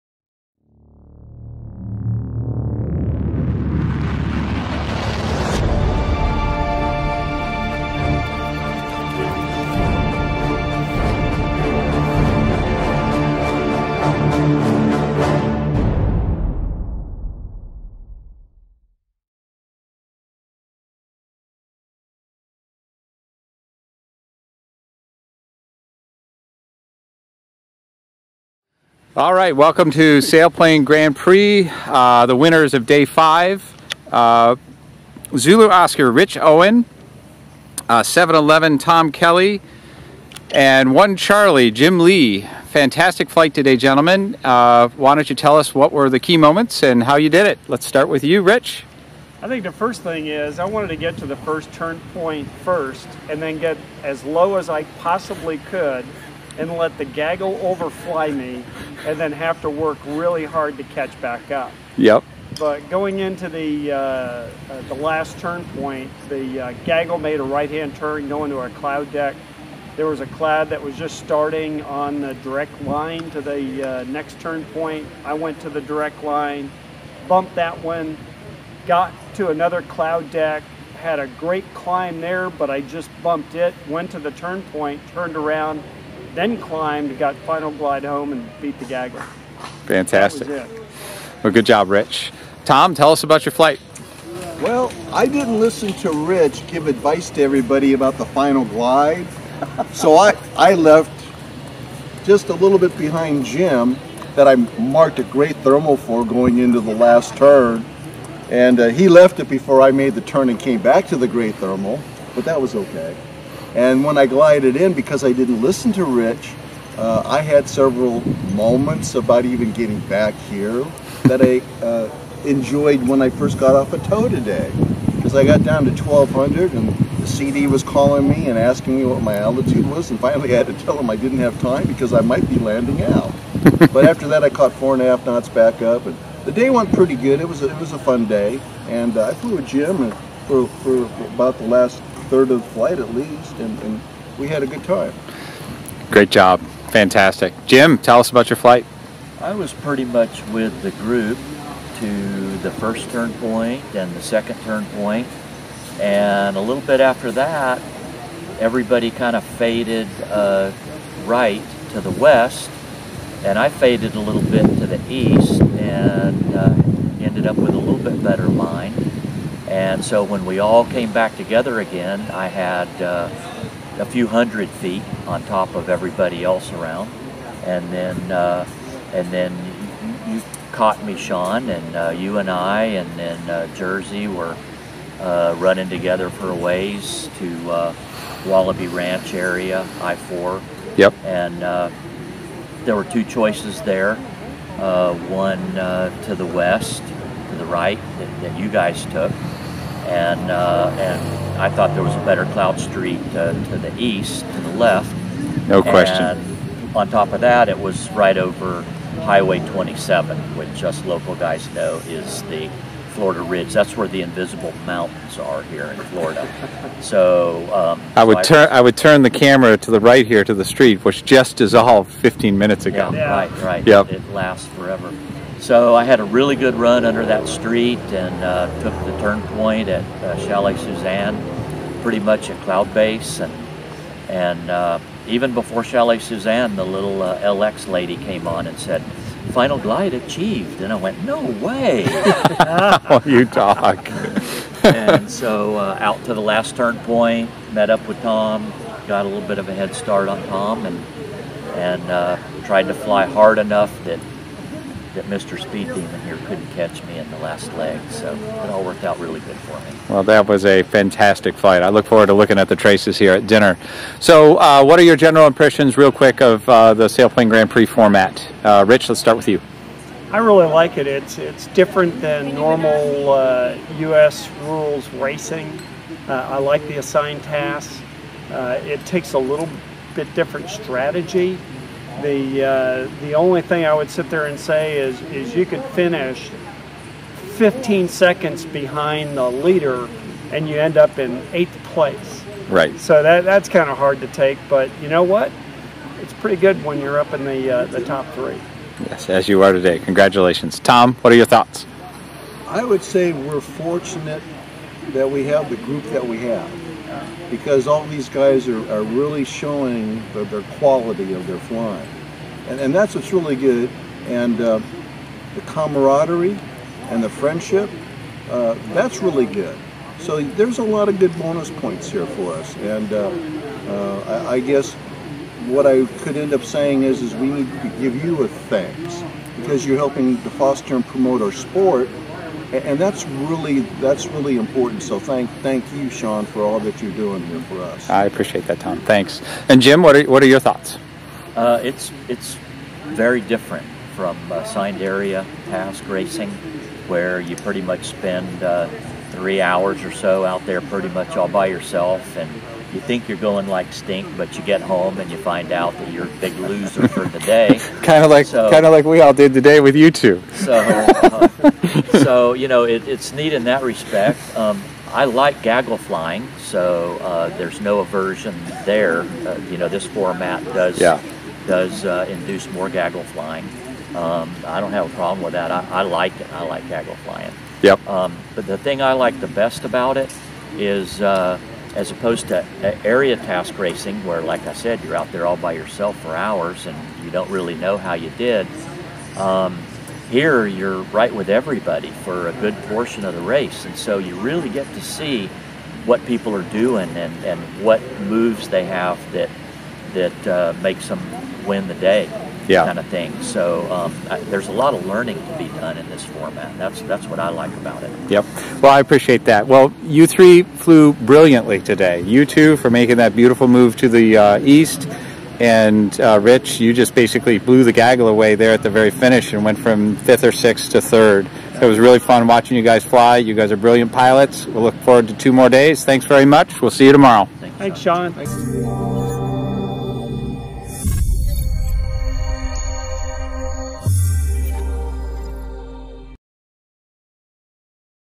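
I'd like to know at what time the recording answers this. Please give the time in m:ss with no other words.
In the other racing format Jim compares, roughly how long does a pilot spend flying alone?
5:49.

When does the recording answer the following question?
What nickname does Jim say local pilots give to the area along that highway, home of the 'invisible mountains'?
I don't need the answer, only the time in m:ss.
3:33.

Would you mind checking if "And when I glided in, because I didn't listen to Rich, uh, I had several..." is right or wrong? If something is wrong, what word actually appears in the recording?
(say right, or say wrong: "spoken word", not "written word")
right.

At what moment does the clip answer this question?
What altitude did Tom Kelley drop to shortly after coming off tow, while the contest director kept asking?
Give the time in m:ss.
2:06.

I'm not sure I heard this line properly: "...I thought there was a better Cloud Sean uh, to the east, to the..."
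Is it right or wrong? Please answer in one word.
wrong.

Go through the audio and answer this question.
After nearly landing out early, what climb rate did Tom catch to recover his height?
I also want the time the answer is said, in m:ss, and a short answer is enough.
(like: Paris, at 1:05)
4.5 knots, at 2:14.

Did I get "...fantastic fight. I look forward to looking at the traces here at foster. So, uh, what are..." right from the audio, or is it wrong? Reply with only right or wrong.
wrong.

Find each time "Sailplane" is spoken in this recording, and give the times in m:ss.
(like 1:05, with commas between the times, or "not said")
0:30, 4:27.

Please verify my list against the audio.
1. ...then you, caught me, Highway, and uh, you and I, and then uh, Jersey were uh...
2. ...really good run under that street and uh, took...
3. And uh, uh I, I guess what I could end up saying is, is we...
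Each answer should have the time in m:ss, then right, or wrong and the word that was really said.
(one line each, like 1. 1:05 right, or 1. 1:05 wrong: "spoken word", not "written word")
1. 2:59 wrong: "Sean", not "Highway"
2. 3:46 right
3. 5:22 right.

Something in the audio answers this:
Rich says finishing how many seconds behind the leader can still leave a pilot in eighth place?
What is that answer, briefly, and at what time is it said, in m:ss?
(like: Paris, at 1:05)
15 seconds, at 4:47.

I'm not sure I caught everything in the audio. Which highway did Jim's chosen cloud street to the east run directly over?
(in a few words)
Highway 27.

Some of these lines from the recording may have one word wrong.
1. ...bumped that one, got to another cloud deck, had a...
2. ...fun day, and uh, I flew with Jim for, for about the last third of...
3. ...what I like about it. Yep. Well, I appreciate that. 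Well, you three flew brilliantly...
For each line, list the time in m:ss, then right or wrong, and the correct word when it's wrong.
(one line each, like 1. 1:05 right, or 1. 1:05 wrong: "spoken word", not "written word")
1. 1:17 right
2. 2:17 right
3. 6:47 right.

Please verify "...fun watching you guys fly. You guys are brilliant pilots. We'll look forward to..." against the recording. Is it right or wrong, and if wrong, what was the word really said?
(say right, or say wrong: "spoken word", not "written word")
right.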